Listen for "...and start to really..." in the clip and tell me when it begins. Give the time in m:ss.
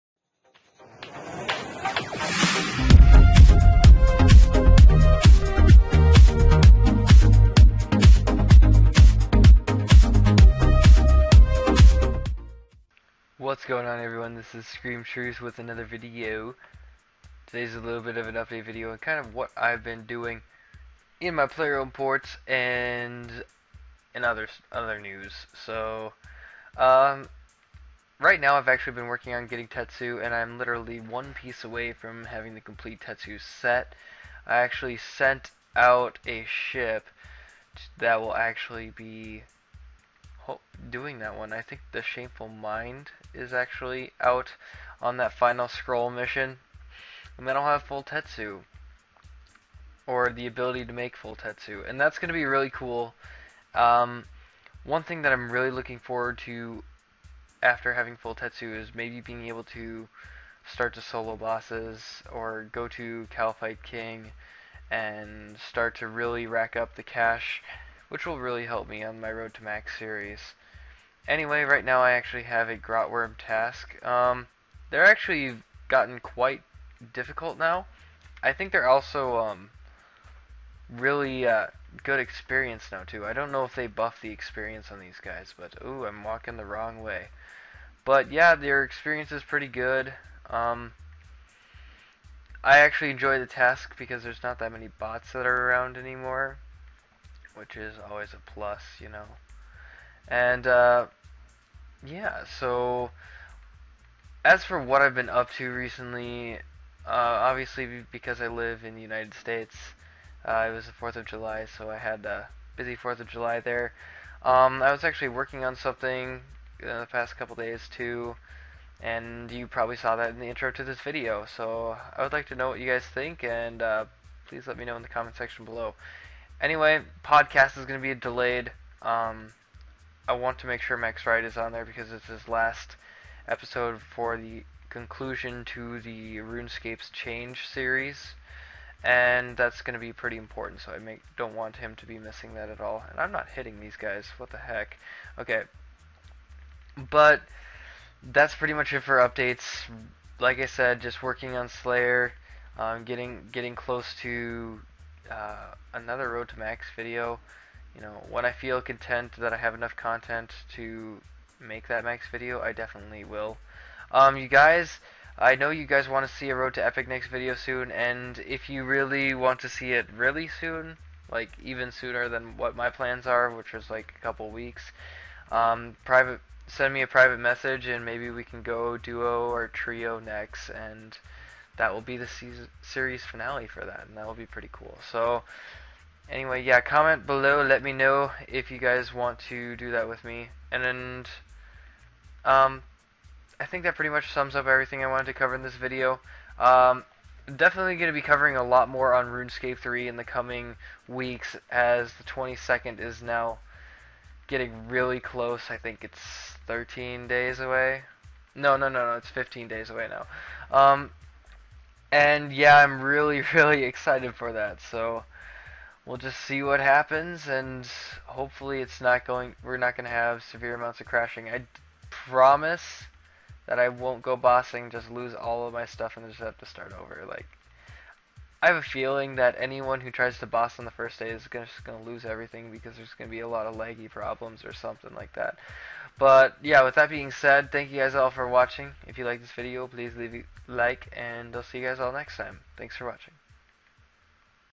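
1:04.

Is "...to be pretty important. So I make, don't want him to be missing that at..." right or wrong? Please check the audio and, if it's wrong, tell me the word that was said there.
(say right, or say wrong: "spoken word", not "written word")
right.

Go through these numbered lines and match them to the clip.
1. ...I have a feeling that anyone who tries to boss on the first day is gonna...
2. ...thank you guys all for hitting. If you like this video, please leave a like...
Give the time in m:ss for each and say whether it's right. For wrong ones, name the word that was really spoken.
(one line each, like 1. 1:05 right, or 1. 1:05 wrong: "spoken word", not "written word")
1. 3:48 right
2. 3:57 wrong: "watching", not "hitting".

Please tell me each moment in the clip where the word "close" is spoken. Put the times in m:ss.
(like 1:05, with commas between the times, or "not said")
2:33, 3:25.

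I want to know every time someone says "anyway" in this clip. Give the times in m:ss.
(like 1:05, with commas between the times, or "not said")
1:11, 2:06, 3:06.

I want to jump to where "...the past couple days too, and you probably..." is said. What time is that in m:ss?
1:57.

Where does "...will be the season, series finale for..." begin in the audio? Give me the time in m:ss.
3:01.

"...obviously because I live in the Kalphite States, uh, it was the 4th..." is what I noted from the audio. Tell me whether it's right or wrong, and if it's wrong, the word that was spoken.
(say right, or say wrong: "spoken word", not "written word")
wrong: "United", not "Kalphite".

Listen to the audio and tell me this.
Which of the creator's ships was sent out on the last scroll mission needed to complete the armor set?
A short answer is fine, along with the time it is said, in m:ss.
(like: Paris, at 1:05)
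Shameful Mind, at 0:42.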